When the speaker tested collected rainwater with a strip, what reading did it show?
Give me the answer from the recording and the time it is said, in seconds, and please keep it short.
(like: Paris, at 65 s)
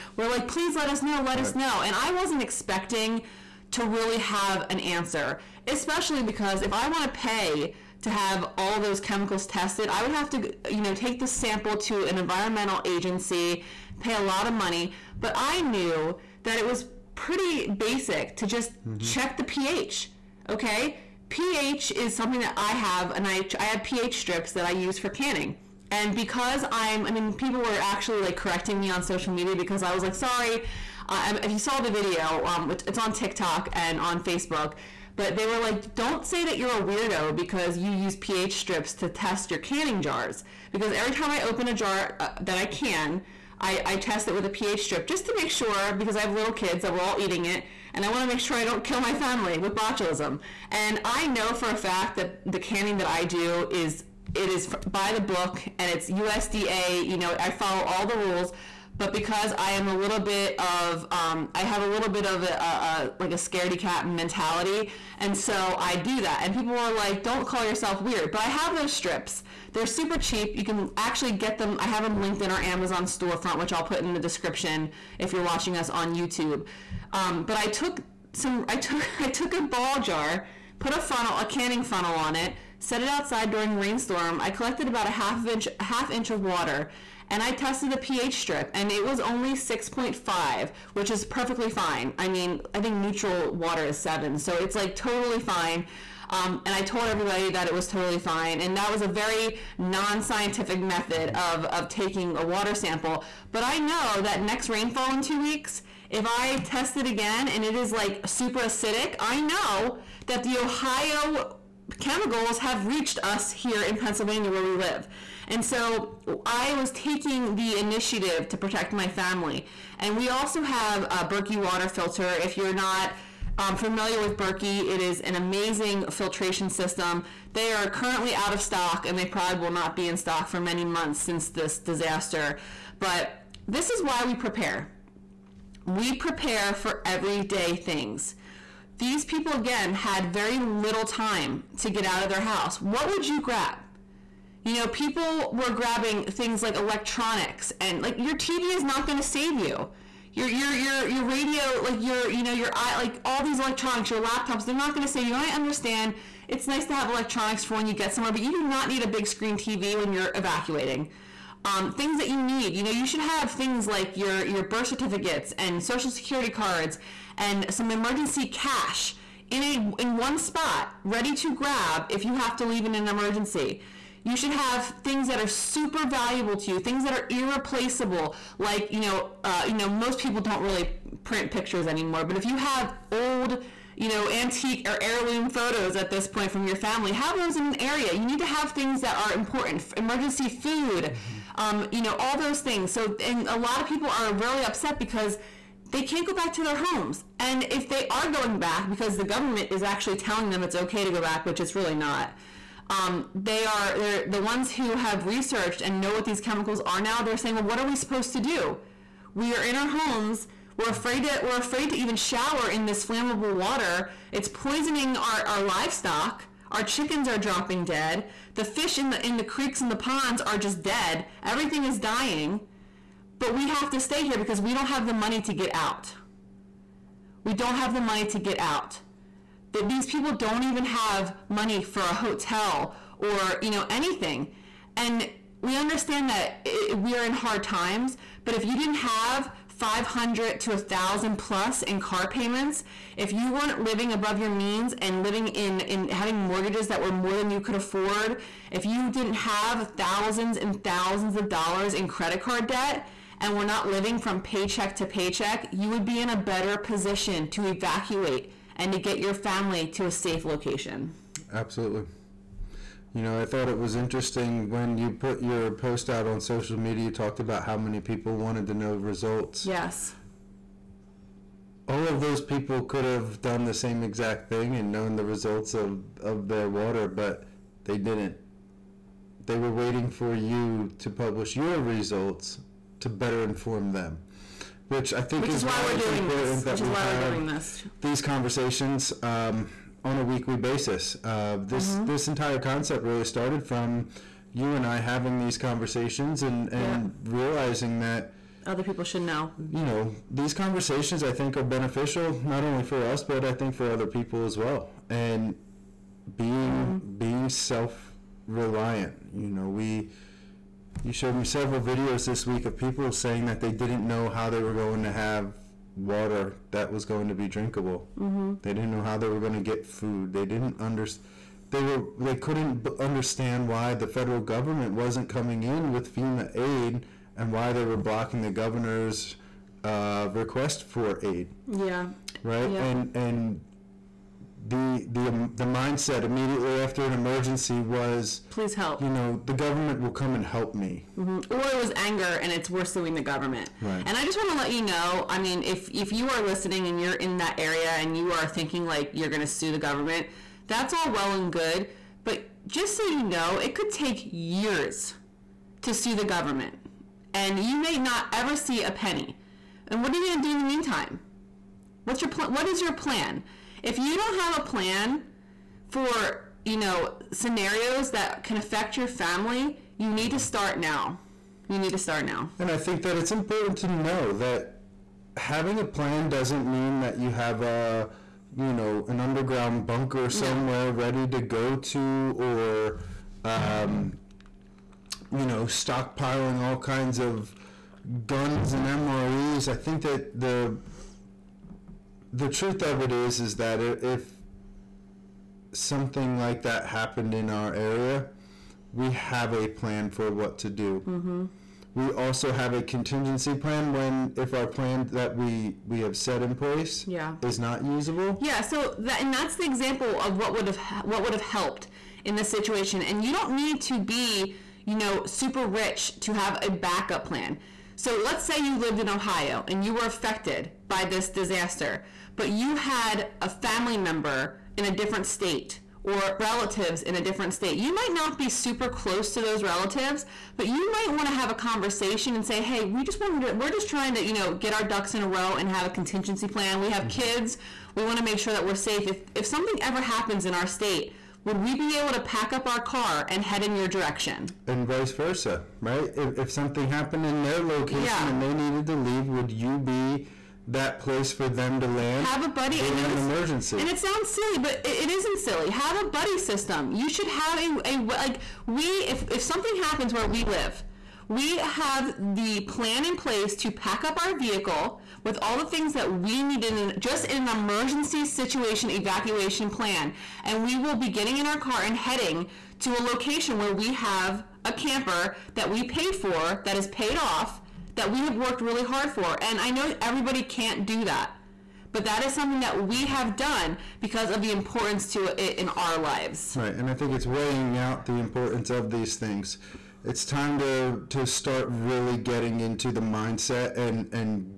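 6.5, at 89 s.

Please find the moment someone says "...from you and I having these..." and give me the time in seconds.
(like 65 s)
293 s.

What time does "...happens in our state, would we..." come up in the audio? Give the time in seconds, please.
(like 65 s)
440 s.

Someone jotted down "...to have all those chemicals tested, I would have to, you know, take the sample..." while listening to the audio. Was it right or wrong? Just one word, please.
right.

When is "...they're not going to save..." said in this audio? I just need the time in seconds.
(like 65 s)
154 s.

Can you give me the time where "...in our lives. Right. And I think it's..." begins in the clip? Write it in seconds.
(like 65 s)
485 s.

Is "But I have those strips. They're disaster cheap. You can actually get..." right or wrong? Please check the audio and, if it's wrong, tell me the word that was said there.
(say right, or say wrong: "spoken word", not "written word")
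wrong: "super", not "disaster".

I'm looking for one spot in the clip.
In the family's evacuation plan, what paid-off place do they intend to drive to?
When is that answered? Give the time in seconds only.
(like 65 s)
474 s.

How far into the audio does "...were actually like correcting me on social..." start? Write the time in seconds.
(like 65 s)
27 s.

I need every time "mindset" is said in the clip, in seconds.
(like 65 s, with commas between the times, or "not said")
335 s, 493 s.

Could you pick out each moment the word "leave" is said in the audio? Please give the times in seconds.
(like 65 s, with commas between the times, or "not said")
172 s, 448 s.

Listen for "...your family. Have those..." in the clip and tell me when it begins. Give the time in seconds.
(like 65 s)
186 s.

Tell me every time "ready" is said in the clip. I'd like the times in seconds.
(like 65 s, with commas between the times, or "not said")
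171 s, 380 s.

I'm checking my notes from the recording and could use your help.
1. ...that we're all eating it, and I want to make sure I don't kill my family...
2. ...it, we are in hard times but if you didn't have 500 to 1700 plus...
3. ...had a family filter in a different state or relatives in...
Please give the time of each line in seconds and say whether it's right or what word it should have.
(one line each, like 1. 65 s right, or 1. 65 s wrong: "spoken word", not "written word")
1. 46 s right
2. 236 s wrong: "1000", not "1700"
3. 422 s wrong: "member", not "filter".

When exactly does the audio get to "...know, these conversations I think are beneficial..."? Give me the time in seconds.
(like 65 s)
299 s.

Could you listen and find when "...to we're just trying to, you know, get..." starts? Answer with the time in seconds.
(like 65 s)
433 s.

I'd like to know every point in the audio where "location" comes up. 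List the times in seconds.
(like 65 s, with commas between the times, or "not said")
260 s, 447 s, 472 s.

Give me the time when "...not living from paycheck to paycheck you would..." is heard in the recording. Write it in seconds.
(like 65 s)
253 s.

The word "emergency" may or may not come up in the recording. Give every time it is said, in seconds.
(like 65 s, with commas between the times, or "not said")
167 s, 173 s, 189 s, 337 s, 453 s, 467 s.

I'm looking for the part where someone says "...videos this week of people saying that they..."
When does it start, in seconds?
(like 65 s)
311 s.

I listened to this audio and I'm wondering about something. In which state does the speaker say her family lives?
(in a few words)
Pennsylvania.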